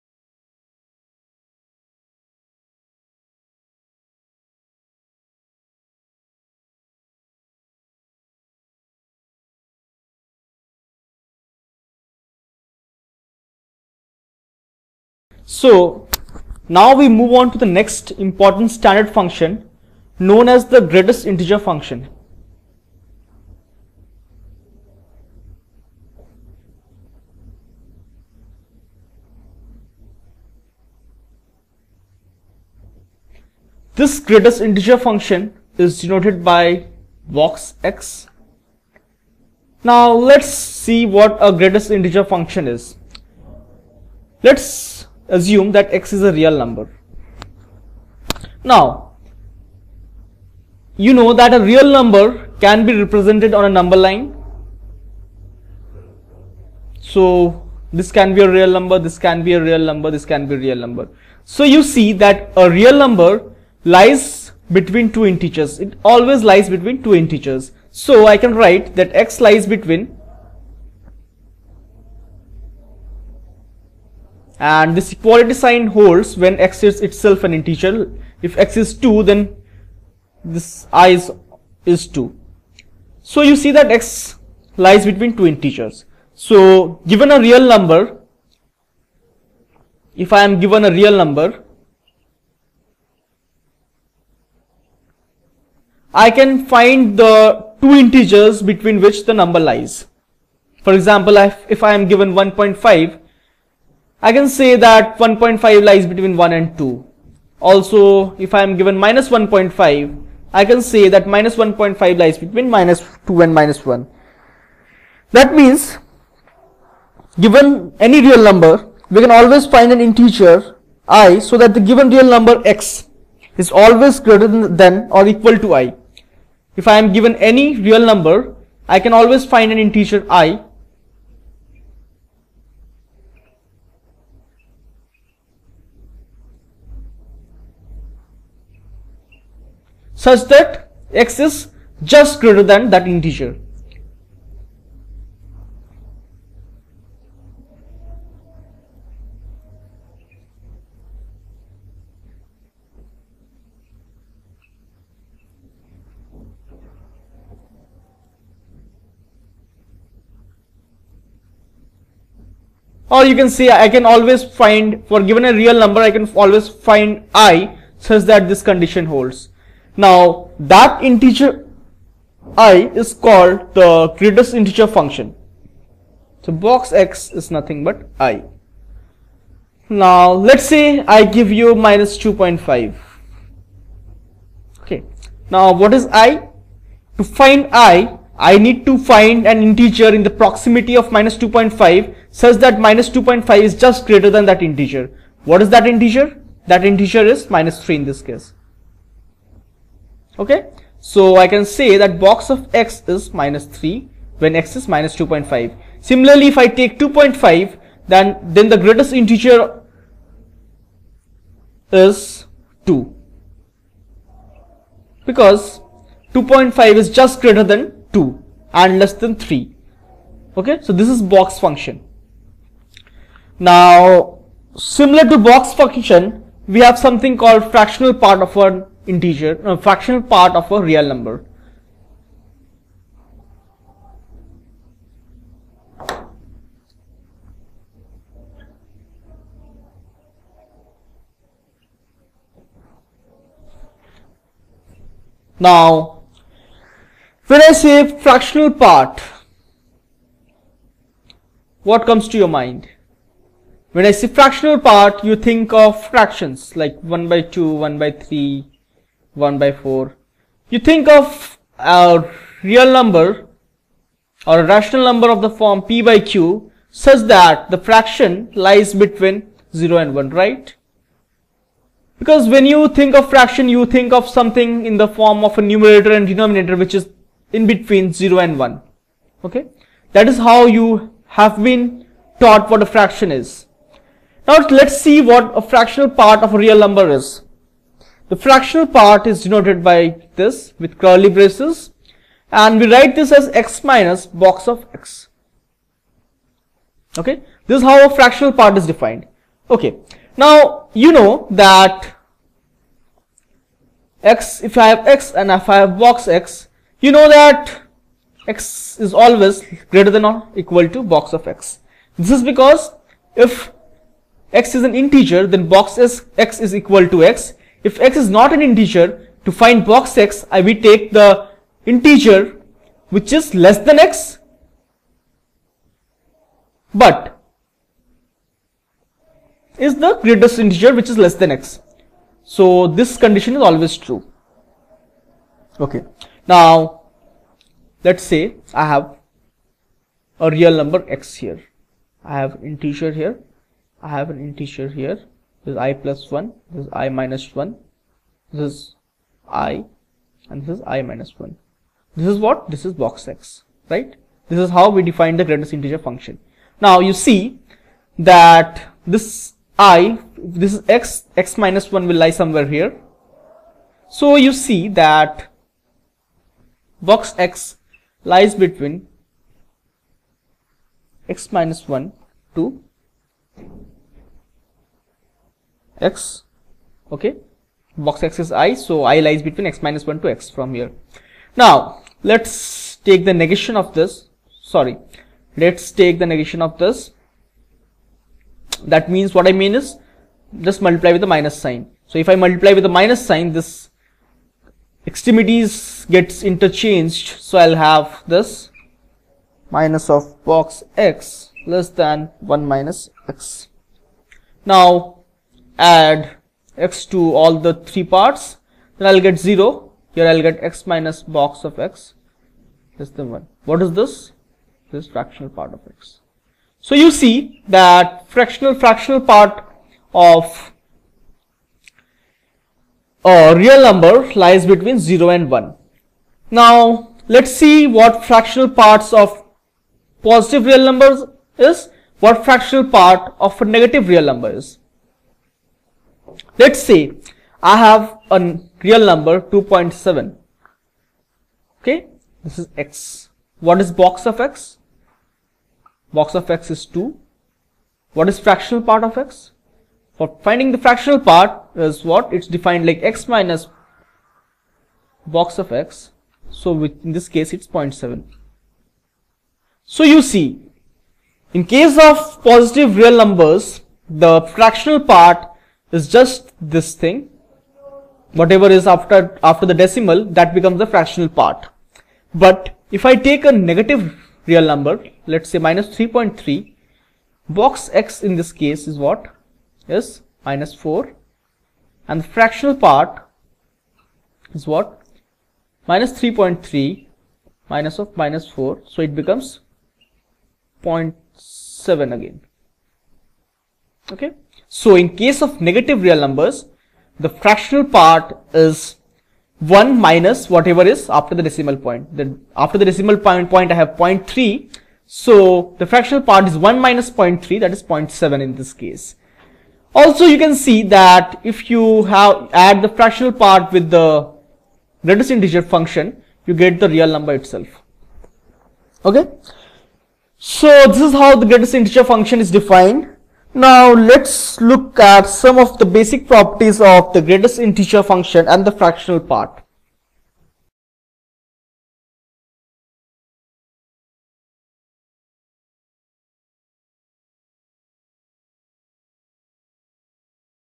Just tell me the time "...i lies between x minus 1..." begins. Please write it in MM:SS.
06:19.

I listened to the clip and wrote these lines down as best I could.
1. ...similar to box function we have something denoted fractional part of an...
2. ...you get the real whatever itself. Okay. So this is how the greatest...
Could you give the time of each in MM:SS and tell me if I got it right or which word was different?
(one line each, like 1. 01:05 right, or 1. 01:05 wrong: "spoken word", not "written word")
1. 03:44 wrong: "called", not "denoted"
2. 08:36 wrong: "number", not "whatever".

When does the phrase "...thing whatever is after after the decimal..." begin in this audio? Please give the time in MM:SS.
07:47.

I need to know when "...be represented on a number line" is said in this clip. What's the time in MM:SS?
00:52.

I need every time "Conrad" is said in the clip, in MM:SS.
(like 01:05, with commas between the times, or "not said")
not said.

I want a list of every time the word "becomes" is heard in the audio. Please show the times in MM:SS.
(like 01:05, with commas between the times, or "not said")
07:50, 08:09.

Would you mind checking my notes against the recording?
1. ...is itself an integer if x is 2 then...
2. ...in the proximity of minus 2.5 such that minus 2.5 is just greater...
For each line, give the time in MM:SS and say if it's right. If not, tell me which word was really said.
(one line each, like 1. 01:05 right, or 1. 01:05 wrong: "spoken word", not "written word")
1. 01:16 right
2. 03:10 right.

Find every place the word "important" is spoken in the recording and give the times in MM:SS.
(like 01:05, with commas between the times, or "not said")
00:18.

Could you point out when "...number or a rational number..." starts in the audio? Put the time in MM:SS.
04:22.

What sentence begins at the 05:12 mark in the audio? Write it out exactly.
This is because if x is an integer, then box is x is equal to x.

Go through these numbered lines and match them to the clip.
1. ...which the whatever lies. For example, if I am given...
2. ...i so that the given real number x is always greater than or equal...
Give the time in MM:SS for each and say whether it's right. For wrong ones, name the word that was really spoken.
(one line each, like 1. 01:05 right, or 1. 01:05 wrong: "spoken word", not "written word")
1. 01:39 wrong: "number", not "whatever"
2. 02:01 right.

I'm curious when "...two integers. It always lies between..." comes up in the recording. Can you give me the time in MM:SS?
01:05.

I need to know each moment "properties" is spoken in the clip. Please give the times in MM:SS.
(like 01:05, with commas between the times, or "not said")
08:46.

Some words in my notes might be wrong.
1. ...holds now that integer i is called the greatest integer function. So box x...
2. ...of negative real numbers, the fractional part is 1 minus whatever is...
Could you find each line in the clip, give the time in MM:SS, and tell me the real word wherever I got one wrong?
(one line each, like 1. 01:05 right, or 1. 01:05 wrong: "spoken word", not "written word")
1. 02:49 right
2. 08:15 right.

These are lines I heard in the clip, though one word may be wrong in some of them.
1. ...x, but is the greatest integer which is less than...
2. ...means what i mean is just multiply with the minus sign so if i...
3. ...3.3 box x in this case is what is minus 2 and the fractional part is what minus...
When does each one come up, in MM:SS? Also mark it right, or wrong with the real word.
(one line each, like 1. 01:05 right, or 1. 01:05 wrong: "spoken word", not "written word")
1. 05:23 right
2. 06:29 right
3. 07:55 wrong: "4", not "2".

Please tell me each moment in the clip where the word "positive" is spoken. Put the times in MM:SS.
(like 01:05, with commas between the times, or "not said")
07:10, 07:42.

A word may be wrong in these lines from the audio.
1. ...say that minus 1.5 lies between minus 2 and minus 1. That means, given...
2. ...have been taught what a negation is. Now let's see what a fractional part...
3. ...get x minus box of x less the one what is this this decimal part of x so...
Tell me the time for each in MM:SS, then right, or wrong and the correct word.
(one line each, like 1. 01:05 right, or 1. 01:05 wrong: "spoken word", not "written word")
1. 01:50 right
2. 04:41 wrong: "fraction", not "negation"
3. 06:50 wrong: "fractional", not "decimal".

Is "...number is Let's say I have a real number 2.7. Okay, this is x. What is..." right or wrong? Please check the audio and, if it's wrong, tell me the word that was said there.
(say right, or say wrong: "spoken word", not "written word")
right.